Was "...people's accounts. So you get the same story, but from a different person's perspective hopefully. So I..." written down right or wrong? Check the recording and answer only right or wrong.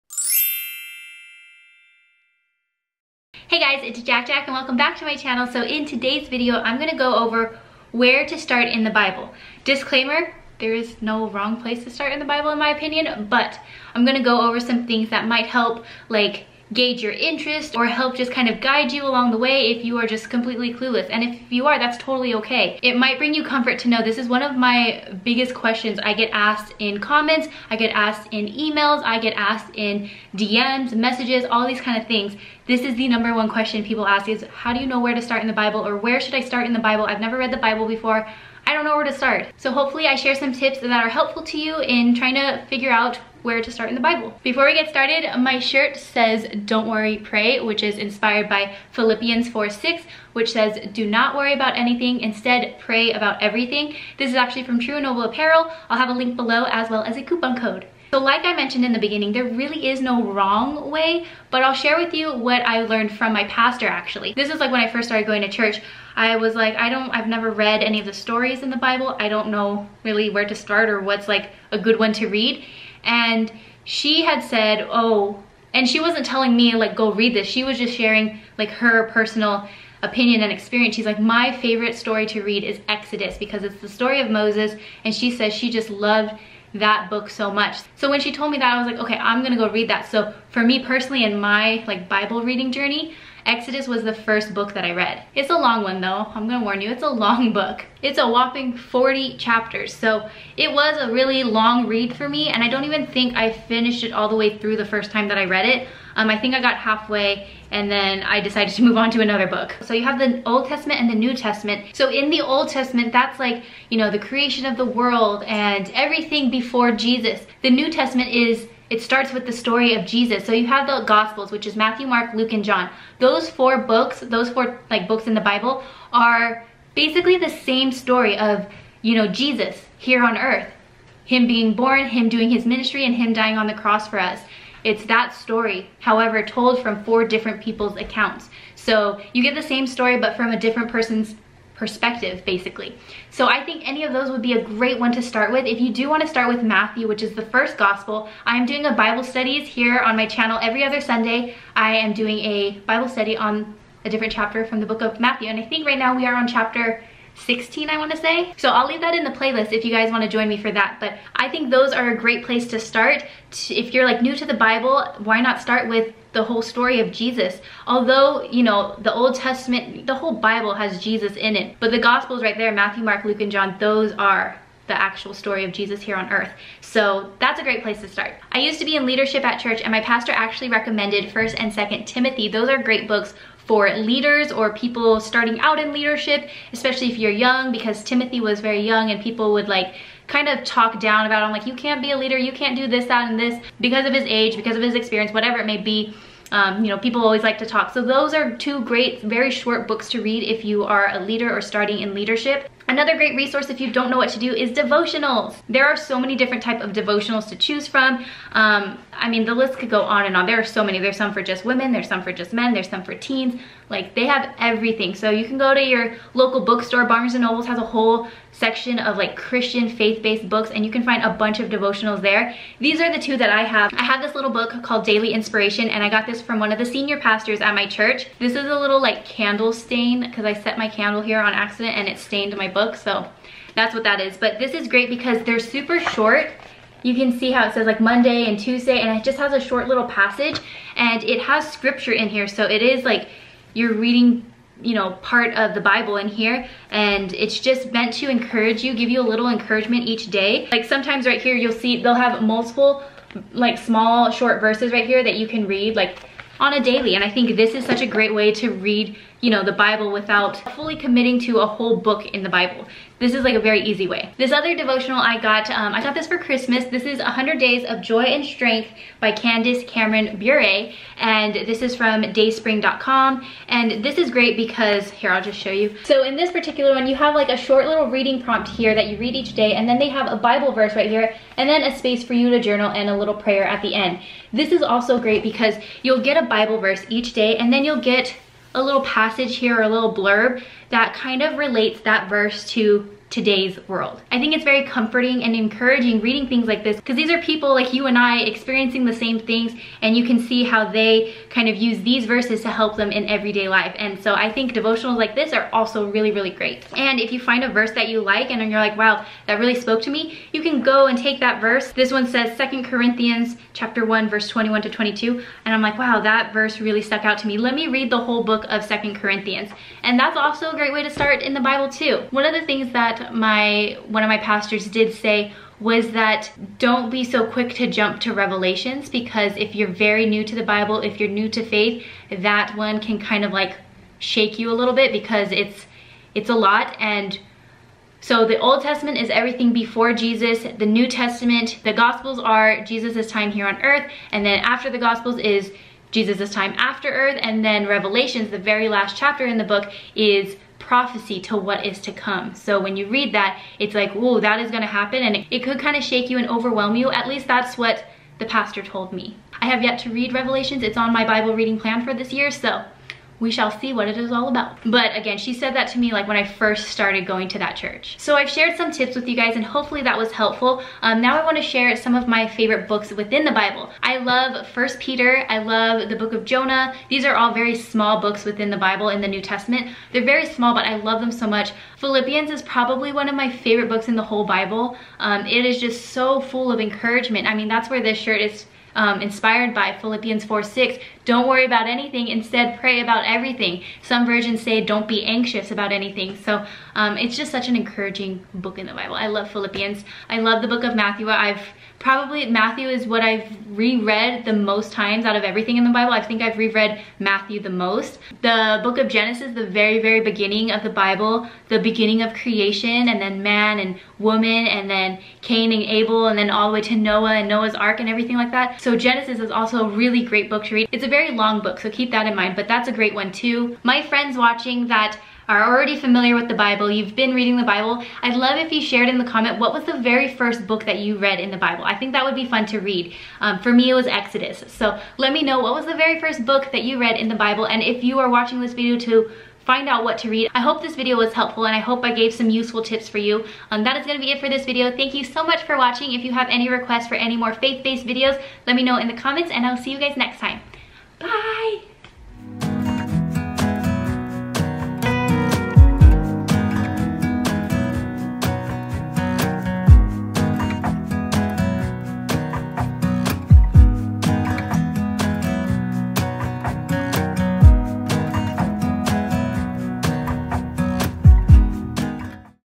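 wrong.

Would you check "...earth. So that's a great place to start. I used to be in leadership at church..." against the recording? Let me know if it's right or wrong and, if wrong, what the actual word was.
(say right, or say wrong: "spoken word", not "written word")
right.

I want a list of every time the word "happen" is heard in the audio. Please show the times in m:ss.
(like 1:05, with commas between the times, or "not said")
5:54.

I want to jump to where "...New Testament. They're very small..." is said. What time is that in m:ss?
6:19.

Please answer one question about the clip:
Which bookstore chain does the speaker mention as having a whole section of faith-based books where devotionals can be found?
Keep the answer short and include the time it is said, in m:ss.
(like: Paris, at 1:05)
Barnes and Nobles, at 3:37.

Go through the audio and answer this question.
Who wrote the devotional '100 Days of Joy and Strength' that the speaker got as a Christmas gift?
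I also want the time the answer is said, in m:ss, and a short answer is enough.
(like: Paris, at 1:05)
Candice Cameron Bure, at 4:29.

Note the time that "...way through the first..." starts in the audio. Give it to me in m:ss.
1:44.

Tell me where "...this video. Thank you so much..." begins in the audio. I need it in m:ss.
7:24.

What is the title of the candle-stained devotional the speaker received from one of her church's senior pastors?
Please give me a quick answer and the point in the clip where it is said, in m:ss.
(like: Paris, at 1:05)
Daily Inspiration, at 3:45.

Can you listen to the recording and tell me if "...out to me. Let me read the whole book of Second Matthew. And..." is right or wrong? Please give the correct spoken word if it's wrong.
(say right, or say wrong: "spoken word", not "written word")
wrong: "Corinthians", not "Matthew".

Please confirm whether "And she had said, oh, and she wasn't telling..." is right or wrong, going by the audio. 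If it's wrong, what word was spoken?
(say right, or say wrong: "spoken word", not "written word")
right.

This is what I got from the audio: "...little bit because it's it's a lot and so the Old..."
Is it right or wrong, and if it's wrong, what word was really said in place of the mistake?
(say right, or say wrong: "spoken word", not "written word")
right.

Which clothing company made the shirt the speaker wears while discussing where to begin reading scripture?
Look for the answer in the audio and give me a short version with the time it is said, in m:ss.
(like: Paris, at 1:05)
True Noble Apparel, at 0:54.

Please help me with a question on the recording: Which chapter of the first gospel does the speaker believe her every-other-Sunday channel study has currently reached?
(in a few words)
16.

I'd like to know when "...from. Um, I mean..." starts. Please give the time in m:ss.
3:27.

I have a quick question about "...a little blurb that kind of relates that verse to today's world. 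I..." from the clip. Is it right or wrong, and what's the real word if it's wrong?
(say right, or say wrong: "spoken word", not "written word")
right.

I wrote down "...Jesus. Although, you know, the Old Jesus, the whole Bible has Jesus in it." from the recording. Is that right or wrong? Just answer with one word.
wrong.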